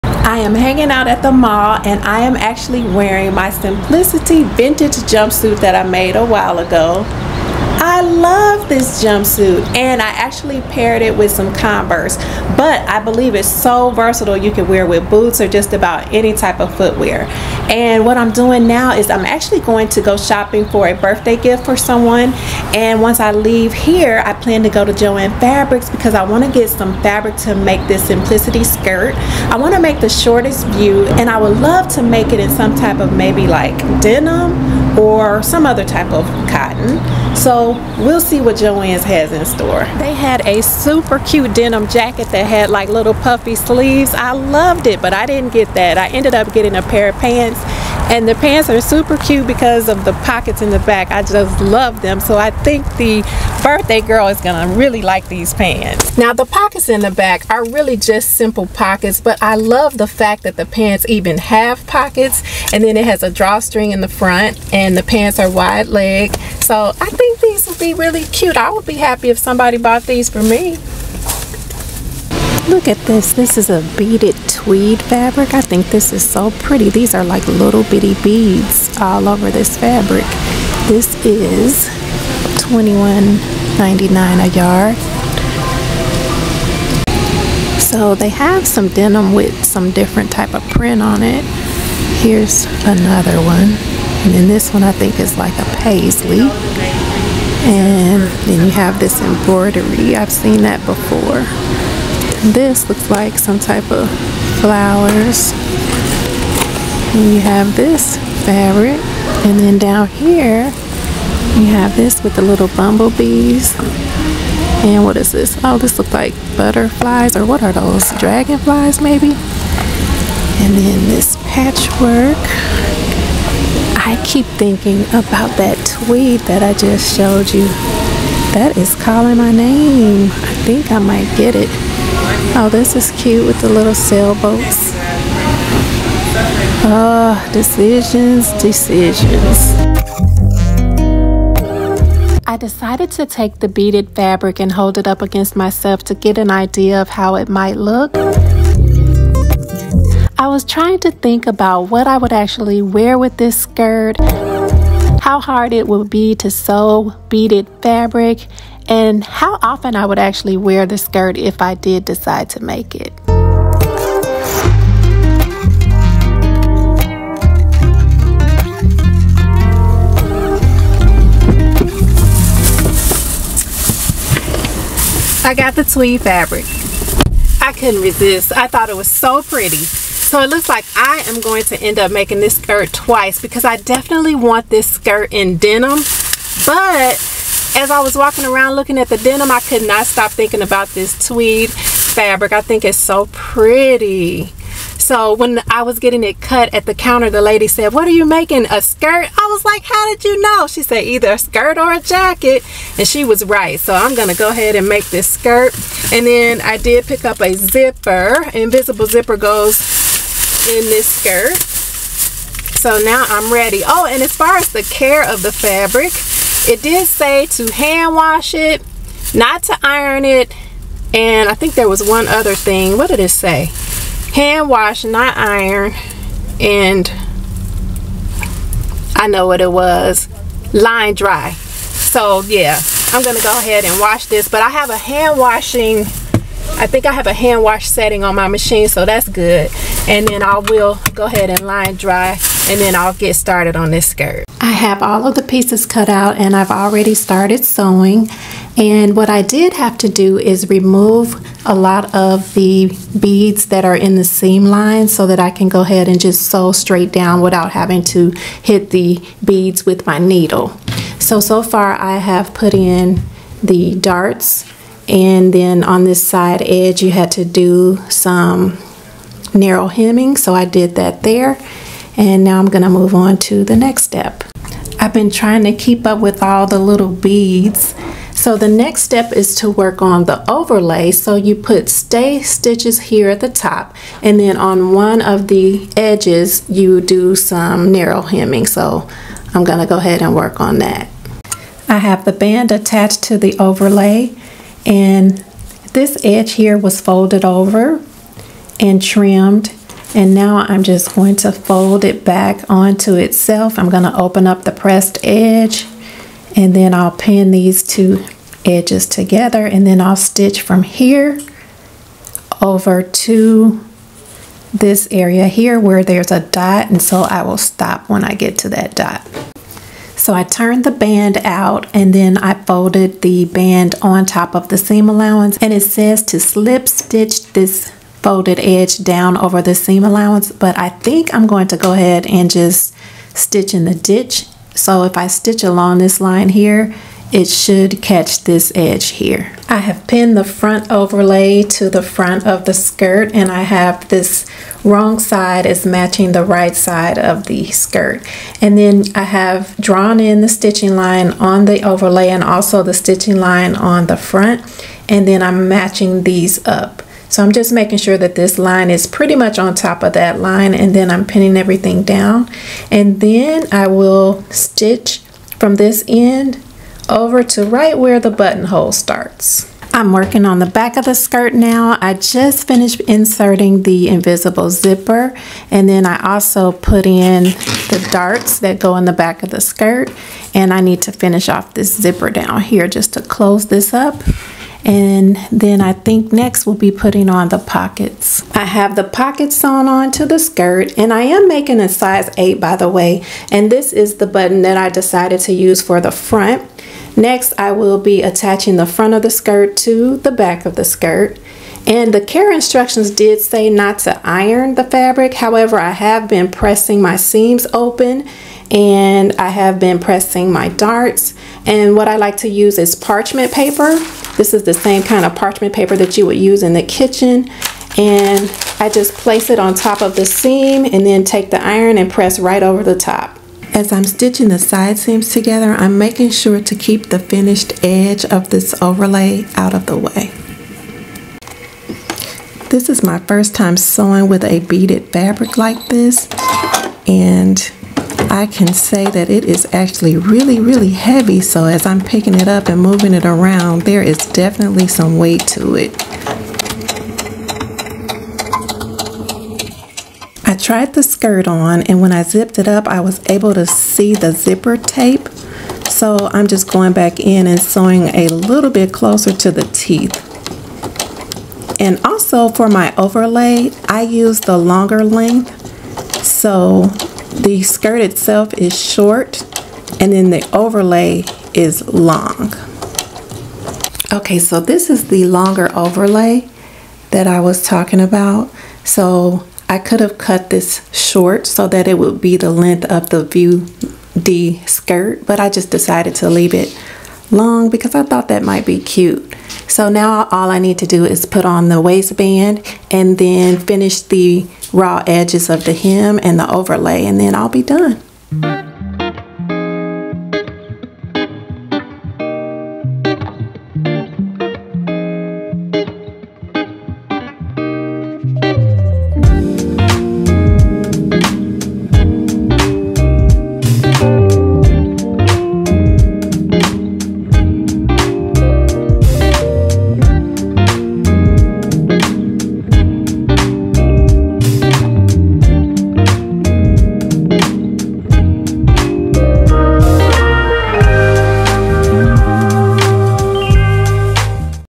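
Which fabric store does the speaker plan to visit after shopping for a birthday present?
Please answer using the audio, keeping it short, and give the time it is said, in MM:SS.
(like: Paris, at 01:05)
Joann Fabrics, at 00:24.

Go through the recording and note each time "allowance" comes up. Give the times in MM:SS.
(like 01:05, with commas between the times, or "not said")
05:25, 05:30.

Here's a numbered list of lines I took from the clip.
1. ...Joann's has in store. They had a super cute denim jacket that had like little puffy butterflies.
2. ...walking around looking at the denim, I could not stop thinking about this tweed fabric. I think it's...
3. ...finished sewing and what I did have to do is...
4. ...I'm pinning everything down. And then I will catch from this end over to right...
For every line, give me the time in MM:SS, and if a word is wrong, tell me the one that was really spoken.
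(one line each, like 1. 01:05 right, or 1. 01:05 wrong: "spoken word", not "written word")
1. 00:38 wrong: "sleeves", not "butterflies"
2. 03:08 right
3. 04:07 wrong: "started", not "finished"
4. 06:01 wrong: "stitch", not "catch".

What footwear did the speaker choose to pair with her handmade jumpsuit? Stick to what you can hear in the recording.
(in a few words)
Converse.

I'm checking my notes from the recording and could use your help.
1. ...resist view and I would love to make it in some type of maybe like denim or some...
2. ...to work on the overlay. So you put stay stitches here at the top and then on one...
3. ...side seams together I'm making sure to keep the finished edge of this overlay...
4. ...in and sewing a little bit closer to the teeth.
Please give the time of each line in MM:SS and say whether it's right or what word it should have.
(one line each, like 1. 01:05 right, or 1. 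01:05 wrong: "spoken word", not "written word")
1. 00:30 wrong: "shortest", not "resist"
2. 04:39 right
3. 07:04 right
4. 07:37 right.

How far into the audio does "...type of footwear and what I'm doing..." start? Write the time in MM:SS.
00:16.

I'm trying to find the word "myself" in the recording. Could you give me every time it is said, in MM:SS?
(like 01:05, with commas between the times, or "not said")
02:25.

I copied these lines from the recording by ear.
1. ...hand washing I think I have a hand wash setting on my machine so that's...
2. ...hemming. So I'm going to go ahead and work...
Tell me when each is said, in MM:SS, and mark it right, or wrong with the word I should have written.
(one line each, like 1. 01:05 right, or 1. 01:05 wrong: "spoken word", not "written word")
1. 03:54 right
2. 04:48 right.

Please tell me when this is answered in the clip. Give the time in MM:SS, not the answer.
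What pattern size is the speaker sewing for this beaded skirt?
06:31.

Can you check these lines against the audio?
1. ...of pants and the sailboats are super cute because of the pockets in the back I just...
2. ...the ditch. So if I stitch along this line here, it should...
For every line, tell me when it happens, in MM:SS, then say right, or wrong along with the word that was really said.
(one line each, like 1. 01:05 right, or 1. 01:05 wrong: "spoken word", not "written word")
1. 00:47 wrong: "pants", not "sailboats"
2. 05:33 right.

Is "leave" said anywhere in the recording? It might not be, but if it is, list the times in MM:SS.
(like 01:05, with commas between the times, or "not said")
00:23, 08:06.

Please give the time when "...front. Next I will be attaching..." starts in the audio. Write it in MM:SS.
06:36.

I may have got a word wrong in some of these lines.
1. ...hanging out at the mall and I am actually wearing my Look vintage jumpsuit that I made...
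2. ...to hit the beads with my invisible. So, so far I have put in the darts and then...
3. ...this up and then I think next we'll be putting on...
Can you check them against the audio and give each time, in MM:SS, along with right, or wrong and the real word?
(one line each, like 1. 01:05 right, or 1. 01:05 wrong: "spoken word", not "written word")
1. 00:00 wrong: "Simplicity", not "Look"
2. 04:18 wrong: "needle", not "invisible"
3. 06:23 right.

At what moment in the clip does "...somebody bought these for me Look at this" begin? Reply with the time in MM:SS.
01:09.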